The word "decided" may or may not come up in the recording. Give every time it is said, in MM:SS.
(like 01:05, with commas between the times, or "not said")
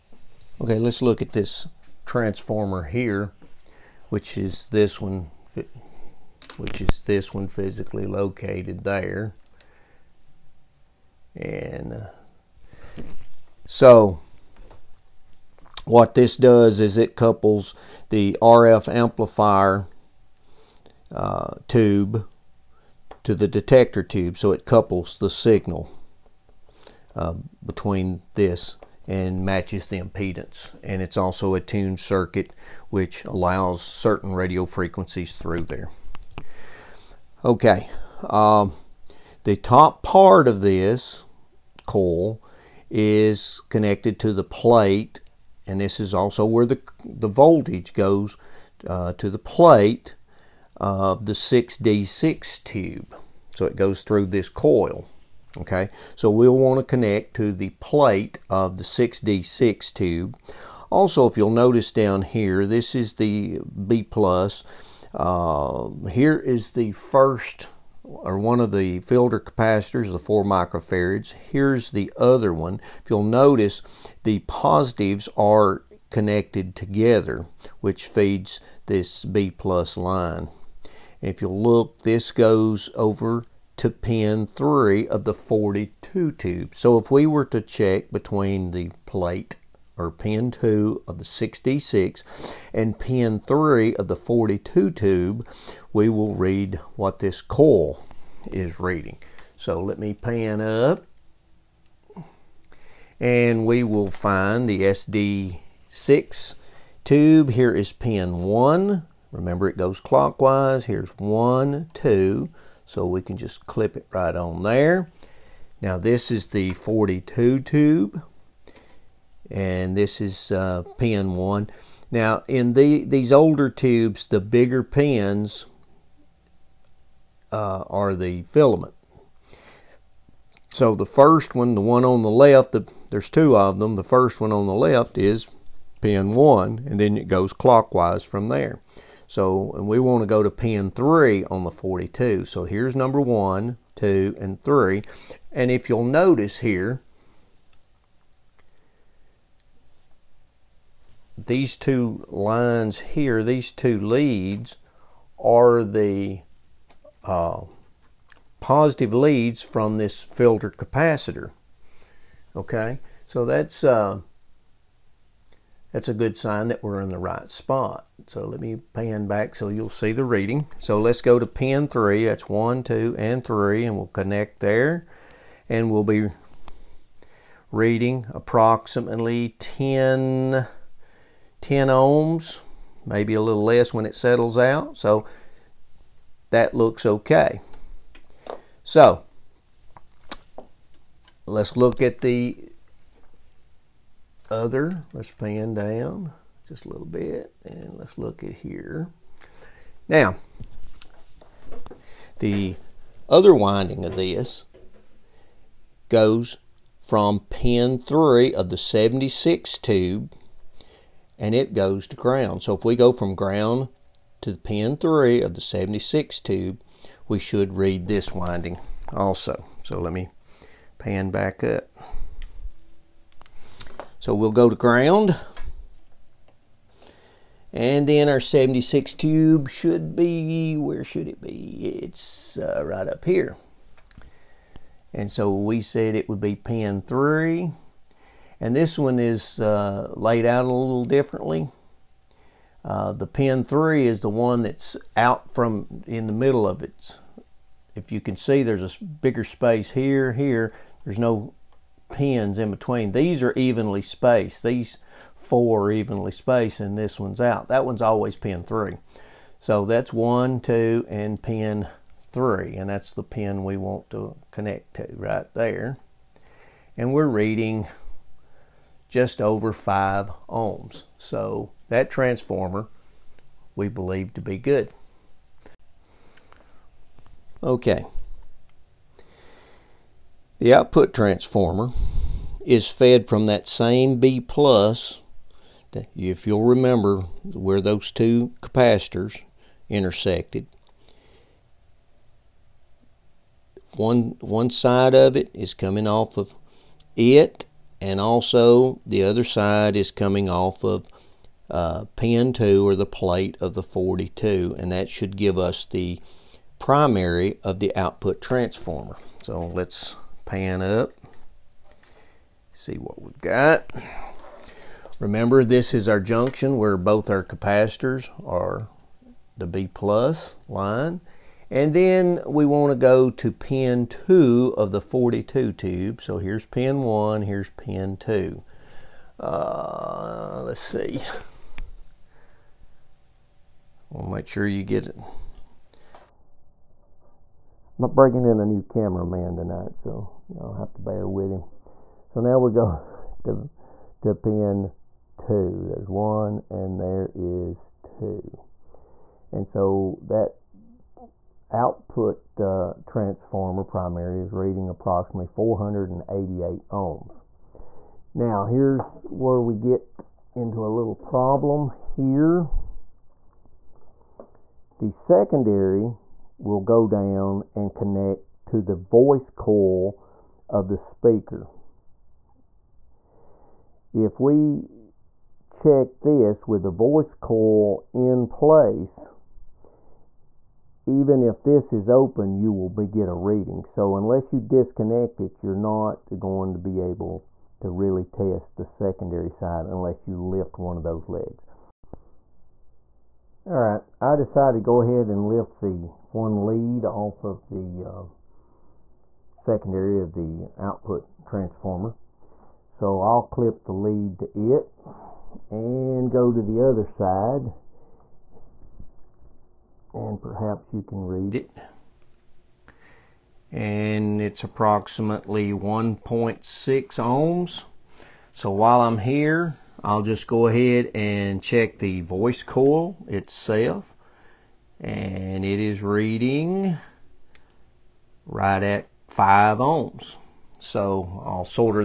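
06:34.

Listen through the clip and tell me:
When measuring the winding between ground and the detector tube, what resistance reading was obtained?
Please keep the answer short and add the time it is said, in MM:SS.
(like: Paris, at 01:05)
just over 5 ohms, at 04:29.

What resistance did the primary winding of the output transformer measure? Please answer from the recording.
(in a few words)
488 ohms.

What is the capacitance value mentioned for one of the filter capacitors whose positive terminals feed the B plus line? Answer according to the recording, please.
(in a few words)
4 microfarads.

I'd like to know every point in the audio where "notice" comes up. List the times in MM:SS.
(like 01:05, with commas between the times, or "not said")
01:01, 01:13, 02:26.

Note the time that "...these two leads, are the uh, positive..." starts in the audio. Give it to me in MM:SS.
02:33.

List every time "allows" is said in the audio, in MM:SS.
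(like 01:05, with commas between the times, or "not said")
00:33.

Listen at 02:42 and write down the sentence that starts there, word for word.
Okay, so that's uh, that's a good sign that we're in the right spot.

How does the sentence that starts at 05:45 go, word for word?
There's 1 and there is 2.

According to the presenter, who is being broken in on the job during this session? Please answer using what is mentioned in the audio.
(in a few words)
a new cameraman.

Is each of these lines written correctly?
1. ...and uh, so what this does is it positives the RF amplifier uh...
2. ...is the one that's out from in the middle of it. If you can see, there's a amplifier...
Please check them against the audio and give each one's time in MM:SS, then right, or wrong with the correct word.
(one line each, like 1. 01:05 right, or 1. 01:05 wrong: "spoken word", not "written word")
1. 00:11 wrong: "couples", not "positives"
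2. 04:04 wrong: "bigger", not "amplifier".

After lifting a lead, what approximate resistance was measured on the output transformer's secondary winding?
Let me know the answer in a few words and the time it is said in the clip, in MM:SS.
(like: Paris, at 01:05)
1.6 ohms, at 06:55.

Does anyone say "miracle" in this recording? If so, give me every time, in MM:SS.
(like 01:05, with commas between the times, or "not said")
not said.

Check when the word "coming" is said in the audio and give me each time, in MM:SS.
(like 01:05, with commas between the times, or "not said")
04:55, 05:00.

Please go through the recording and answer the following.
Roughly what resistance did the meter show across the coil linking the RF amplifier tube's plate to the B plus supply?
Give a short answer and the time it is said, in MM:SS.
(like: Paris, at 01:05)
10 ohms, at 03:01.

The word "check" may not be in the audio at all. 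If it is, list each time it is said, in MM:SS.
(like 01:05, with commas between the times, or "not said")
01:27, 06:15, 07:01.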